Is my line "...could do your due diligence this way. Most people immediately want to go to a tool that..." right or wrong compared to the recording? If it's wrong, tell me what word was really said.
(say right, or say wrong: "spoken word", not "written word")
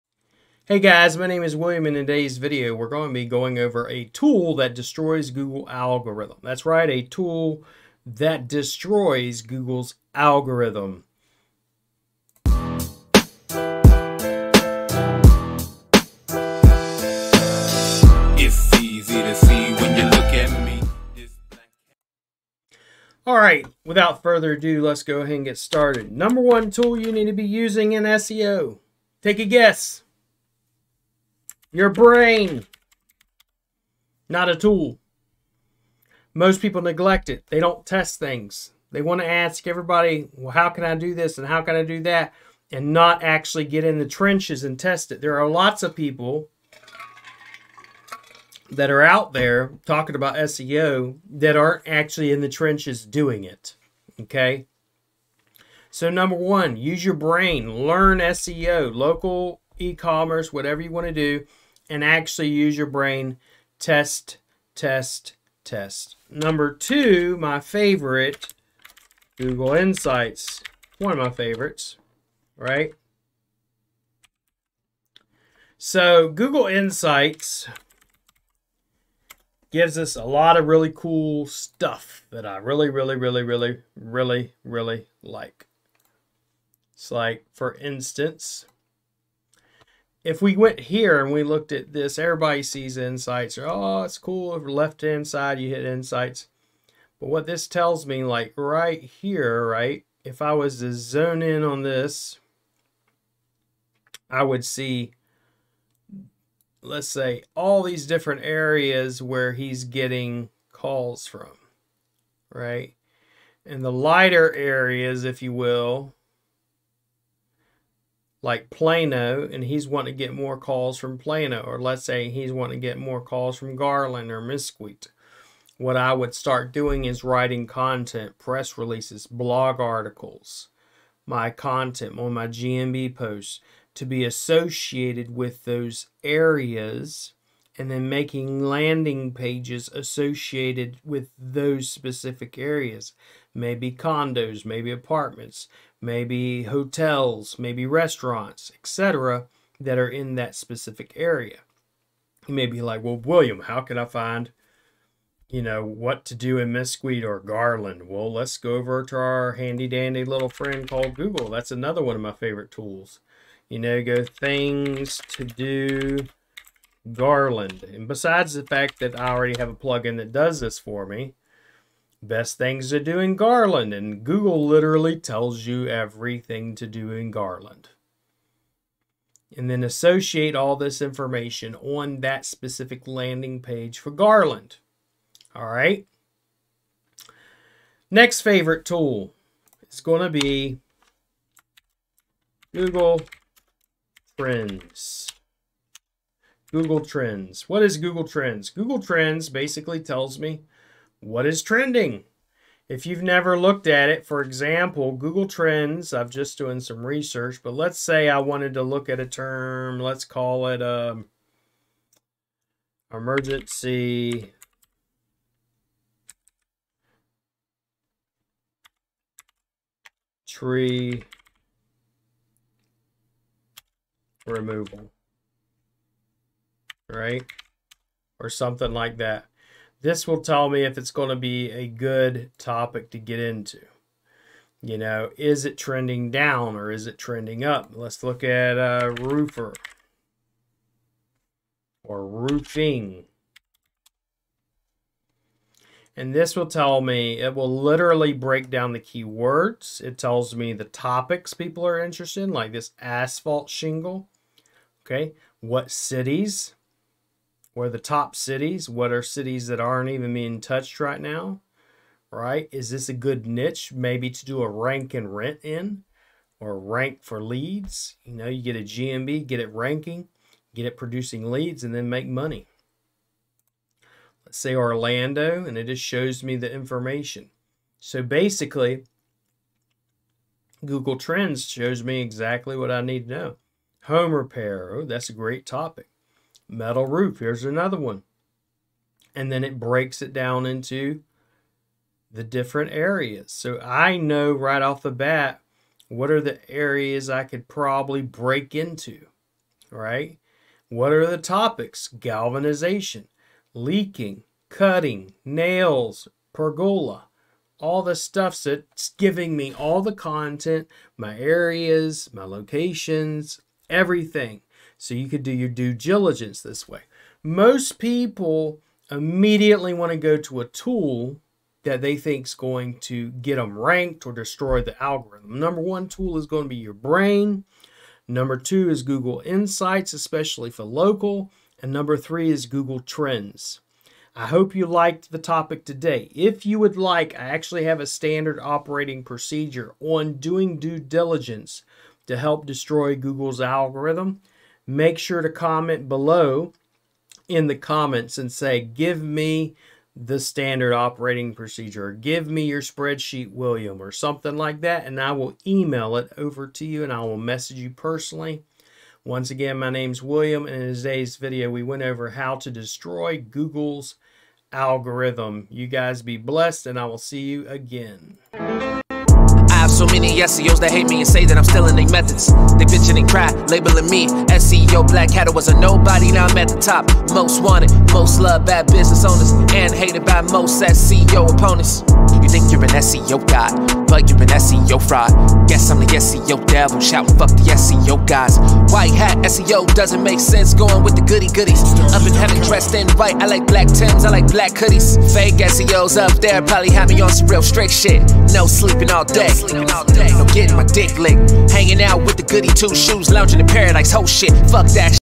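right.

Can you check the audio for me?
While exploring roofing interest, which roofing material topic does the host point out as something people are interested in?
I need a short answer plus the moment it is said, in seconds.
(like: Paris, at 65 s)
asphalt shingle, at 252 s.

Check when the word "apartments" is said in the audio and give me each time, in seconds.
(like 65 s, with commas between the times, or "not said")
144 s.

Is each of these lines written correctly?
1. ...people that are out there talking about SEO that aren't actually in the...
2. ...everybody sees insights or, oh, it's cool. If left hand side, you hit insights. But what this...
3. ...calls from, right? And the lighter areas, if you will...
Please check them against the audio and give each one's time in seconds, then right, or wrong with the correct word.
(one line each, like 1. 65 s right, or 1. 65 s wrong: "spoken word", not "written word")
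1. 45 s right
2. 92 s right
3. 110 s right.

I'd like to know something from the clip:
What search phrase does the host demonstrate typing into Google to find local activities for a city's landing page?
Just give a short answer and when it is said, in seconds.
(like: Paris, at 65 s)
things to do Garland, at 164 s.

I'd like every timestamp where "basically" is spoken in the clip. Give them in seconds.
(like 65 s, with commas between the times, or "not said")
199 s, 278 s.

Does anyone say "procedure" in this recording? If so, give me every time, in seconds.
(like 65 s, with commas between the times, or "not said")
339 s, 351 s.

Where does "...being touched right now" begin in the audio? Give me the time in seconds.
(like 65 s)
260 s.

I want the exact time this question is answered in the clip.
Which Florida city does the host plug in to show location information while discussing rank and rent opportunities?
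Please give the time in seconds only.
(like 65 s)
274 s.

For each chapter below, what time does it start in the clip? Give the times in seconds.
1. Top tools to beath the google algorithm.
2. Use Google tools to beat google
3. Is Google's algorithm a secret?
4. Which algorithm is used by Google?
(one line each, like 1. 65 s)
1. 195 s
2. 255 s
3. 85 s
4. 114 s.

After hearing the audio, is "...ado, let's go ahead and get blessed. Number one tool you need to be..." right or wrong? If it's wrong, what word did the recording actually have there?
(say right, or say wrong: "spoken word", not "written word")
wrong: "started", not "blessed".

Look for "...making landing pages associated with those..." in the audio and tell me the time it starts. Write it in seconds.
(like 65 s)
138 s.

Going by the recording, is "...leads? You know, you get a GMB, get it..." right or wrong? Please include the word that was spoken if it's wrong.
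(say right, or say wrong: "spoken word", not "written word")
right.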